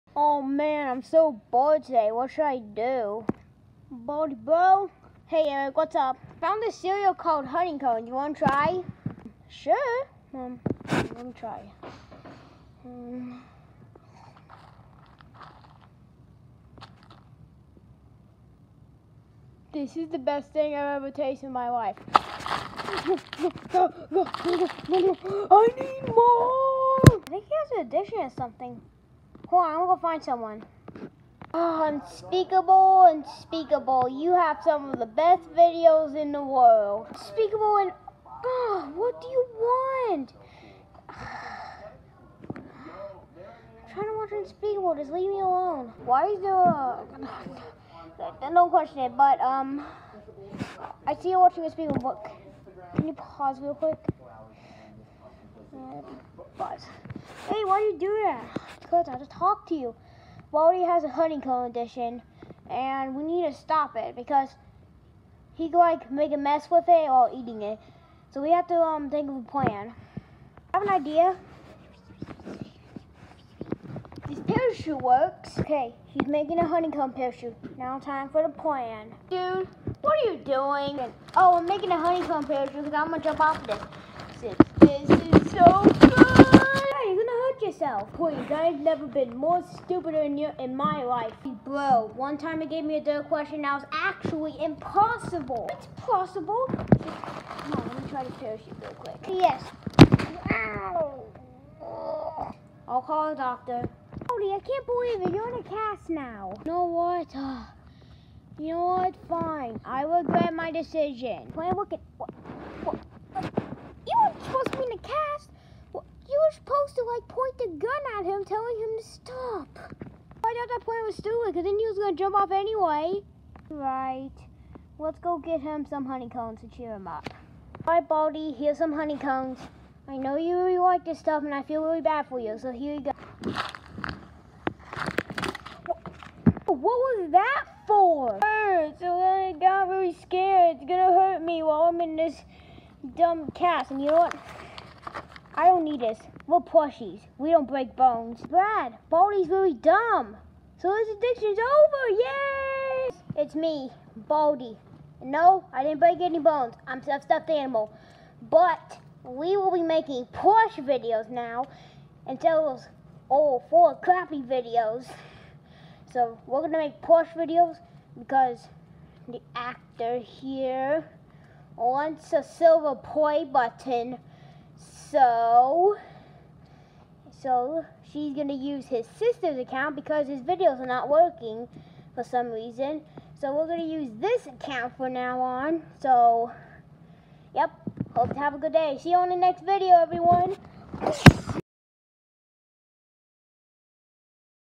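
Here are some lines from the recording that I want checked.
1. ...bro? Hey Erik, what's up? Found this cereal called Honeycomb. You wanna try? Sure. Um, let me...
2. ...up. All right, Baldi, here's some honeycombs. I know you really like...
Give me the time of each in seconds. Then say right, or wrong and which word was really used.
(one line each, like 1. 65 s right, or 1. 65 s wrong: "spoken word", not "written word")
1. 4 s right
2. 127 s right.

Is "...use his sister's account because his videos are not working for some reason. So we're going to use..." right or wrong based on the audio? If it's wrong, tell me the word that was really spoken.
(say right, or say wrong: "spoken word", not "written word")
right.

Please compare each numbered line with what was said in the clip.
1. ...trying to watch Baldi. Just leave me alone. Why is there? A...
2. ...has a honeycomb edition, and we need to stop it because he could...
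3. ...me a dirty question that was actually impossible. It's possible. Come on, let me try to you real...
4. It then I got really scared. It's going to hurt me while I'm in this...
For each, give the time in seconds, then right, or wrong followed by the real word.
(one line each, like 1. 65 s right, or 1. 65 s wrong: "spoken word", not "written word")
1. 43 s wrong: "Unspeakable", not "Baldi"
2. 60 s right
3. 92 s right
4. 138 s right.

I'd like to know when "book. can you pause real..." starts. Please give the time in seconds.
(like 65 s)
51 s.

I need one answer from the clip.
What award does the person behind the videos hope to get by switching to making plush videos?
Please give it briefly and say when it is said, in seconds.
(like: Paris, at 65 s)
Silver play button, at 172 s.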